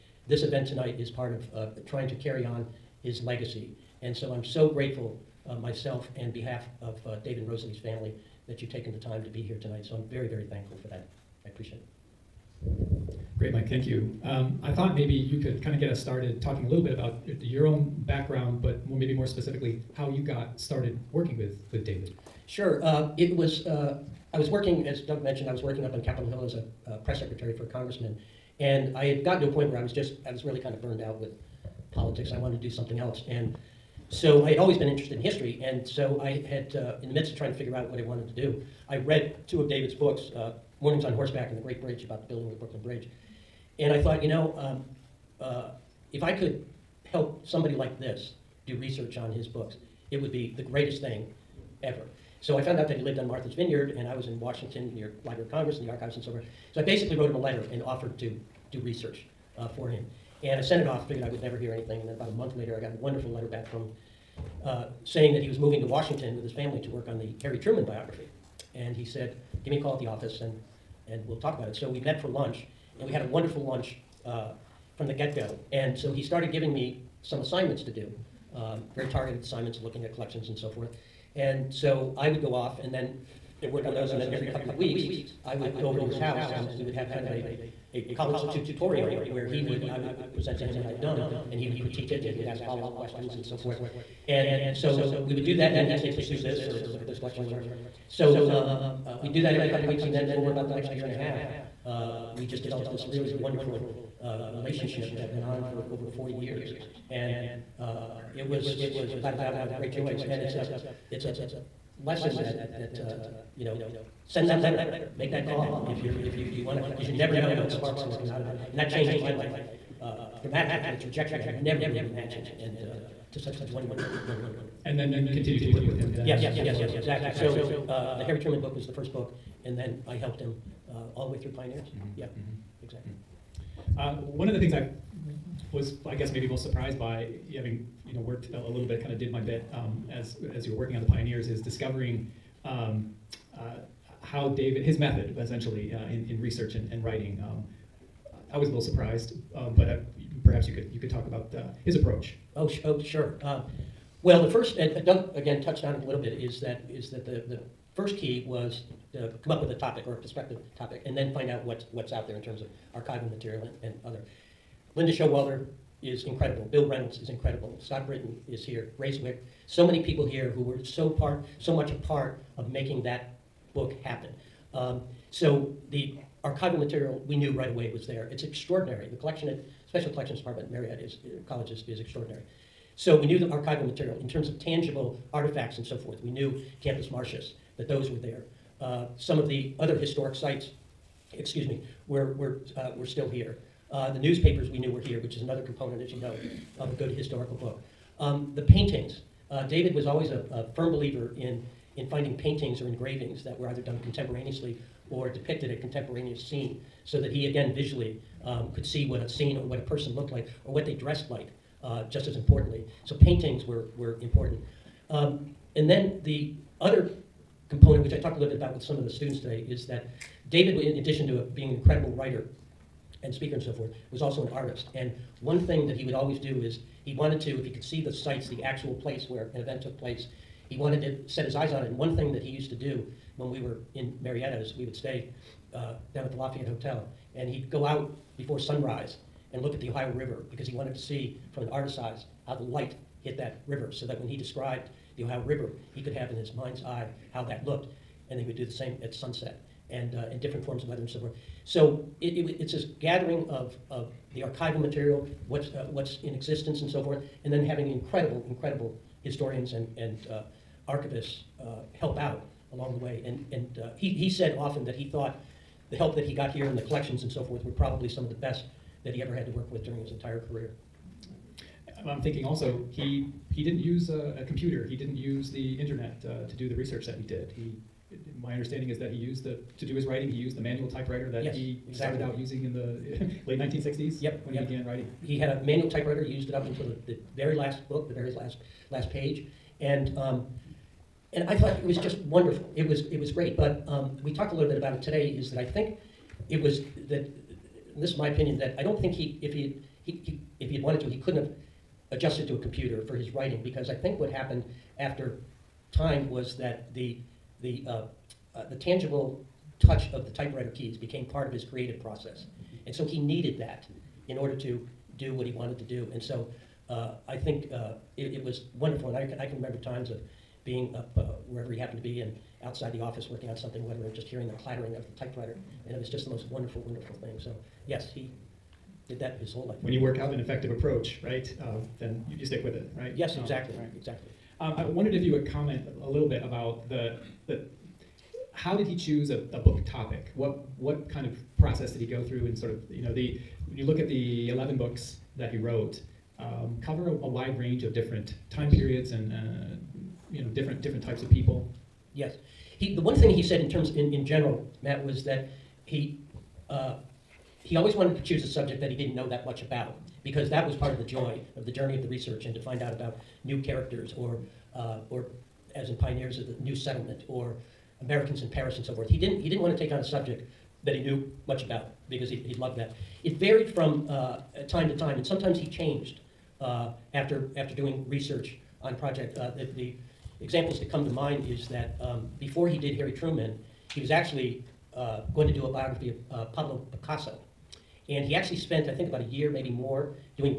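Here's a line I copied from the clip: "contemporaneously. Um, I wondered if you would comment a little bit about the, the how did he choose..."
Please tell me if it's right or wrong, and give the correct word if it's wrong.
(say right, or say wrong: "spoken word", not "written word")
wrong: "exactly", not "contemporaneously".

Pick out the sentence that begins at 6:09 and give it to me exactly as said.
He didn't, he didn't want to take on a subject that he knew much about because he, he loved that.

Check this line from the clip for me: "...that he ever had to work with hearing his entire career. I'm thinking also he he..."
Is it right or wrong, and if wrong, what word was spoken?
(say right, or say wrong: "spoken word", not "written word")
wrong: "during", not "hearing".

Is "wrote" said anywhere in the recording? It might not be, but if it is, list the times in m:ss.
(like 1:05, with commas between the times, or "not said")
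0:57, 5:45.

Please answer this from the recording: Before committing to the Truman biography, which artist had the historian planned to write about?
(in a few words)
Pablo Picasso.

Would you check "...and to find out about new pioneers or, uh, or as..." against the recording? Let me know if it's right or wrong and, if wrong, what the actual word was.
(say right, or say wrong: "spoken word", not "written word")
wrong: "characters", not "pioneers".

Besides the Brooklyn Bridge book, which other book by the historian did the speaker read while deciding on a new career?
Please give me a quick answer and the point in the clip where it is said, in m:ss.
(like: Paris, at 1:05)
Mornings on Horseback, at 0:40.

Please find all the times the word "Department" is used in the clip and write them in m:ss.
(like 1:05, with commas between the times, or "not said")
3:00.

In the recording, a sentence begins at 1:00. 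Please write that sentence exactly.
And I sent it off, figured I would never hear anything.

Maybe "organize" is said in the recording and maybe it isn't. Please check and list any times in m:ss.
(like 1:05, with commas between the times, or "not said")
not said.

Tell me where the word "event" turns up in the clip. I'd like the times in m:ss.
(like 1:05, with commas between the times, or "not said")
0:00, 3:49.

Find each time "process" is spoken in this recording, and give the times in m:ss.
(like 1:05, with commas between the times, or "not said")
5:12, 5:41.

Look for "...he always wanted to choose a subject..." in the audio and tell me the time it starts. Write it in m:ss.
5:57.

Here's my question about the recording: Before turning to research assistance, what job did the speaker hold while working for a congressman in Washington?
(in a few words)
Press secretary.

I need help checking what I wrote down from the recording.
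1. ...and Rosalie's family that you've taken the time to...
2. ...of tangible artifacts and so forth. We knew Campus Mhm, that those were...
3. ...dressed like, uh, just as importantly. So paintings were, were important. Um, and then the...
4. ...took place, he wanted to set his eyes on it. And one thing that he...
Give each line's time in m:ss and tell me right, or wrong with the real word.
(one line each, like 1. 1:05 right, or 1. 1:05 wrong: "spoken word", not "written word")
1. 0:07 right
2. 3:04 wrong: "Martius", not "Mhm"
3. 3:30 right
4. 3:49 right.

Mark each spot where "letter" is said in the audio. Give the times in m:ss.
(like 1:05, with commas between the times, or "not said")
0:57, 1:03, 1:54.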